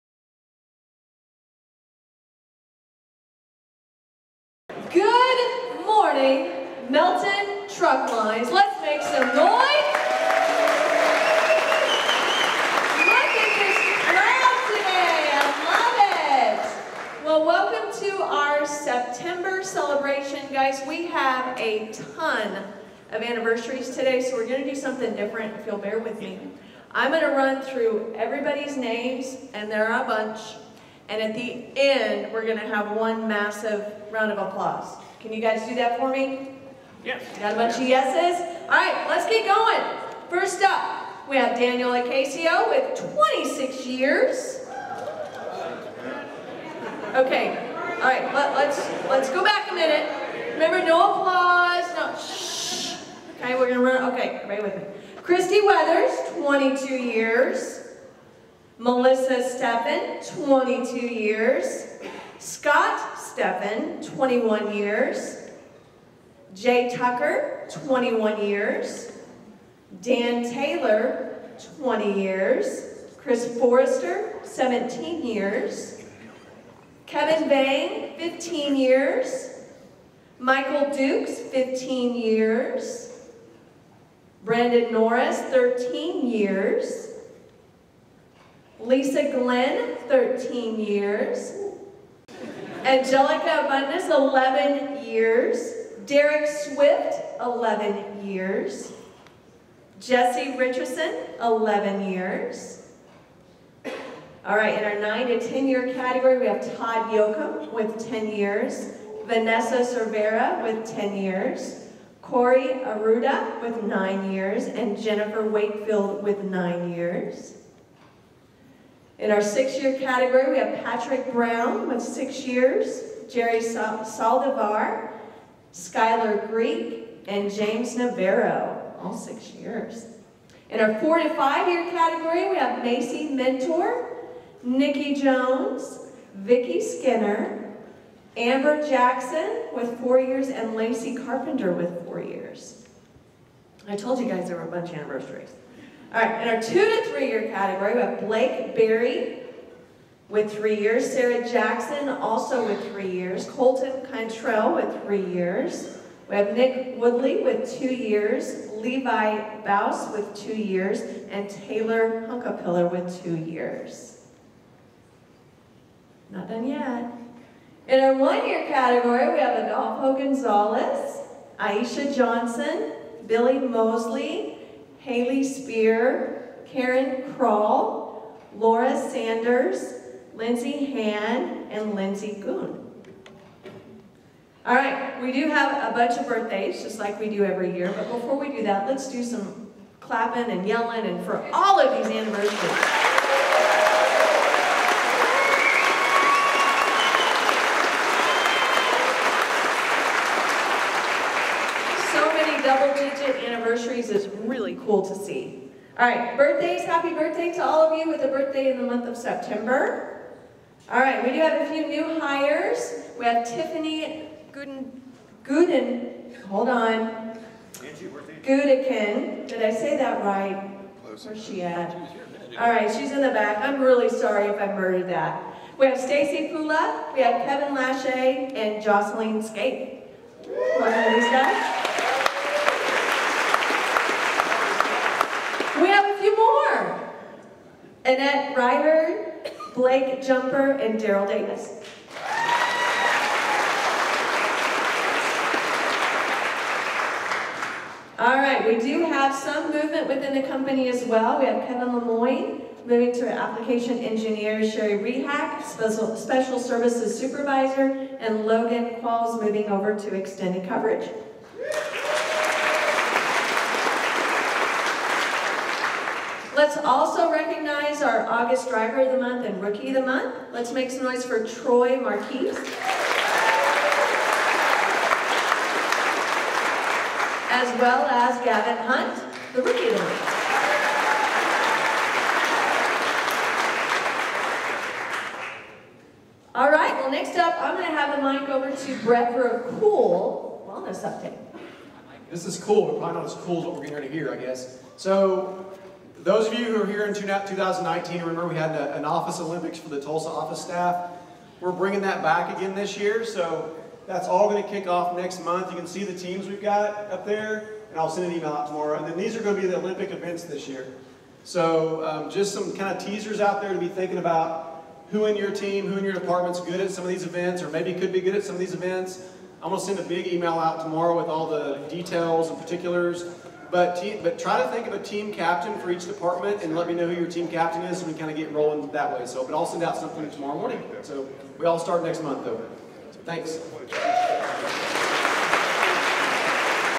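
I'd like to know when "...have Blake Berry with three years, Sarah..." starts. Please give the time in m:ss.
2:28.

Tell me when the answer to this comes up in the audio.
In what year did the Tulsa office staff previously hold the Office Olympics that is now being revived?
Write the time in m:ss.
4:57.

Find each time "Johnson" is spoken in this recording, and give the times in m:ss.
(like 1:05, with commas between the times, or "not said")
2:52.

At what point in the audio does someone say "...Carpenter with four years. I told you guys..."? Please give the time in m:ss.
2:21.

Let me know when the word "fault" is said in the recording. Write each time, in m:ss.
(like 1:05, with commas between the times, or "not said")
not said.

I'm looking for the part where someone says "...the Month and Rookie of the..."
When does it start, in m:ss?
4:29.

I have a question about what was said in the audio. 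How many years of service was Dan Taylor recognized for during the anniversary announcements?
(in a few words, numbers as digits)
20 years.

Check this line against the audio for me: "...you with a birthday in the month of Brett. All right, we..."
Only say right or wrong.
wrong.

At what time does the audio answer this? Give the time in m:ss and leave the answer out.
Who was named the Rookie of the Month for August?
4:38.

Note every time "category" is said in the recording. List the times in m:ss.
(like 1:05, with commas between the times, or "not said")
1:45, 1:59, 2:11, 2:27, 2:48.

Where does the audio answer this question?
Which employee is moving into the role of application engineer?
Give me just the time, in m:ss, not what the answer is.
4:11.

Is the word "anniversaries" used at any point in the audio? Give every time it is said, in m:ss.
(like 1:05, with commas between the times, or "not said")
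0:23, 2:24, 3:12, 3:23.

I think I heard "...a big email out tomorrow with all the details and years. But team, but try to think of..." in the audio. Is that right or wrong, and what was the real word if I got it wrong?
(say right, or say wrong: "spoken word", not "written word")
wrong: "particulars", not "years".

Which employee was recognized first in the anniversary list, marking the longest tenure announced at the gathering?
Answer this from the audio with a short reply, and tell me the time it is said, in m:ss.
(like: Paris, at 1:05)
Daniel Acasio, at 0:41.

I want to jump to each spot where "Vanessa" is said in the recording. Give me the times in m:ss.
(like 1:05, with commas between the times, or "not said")
1:49.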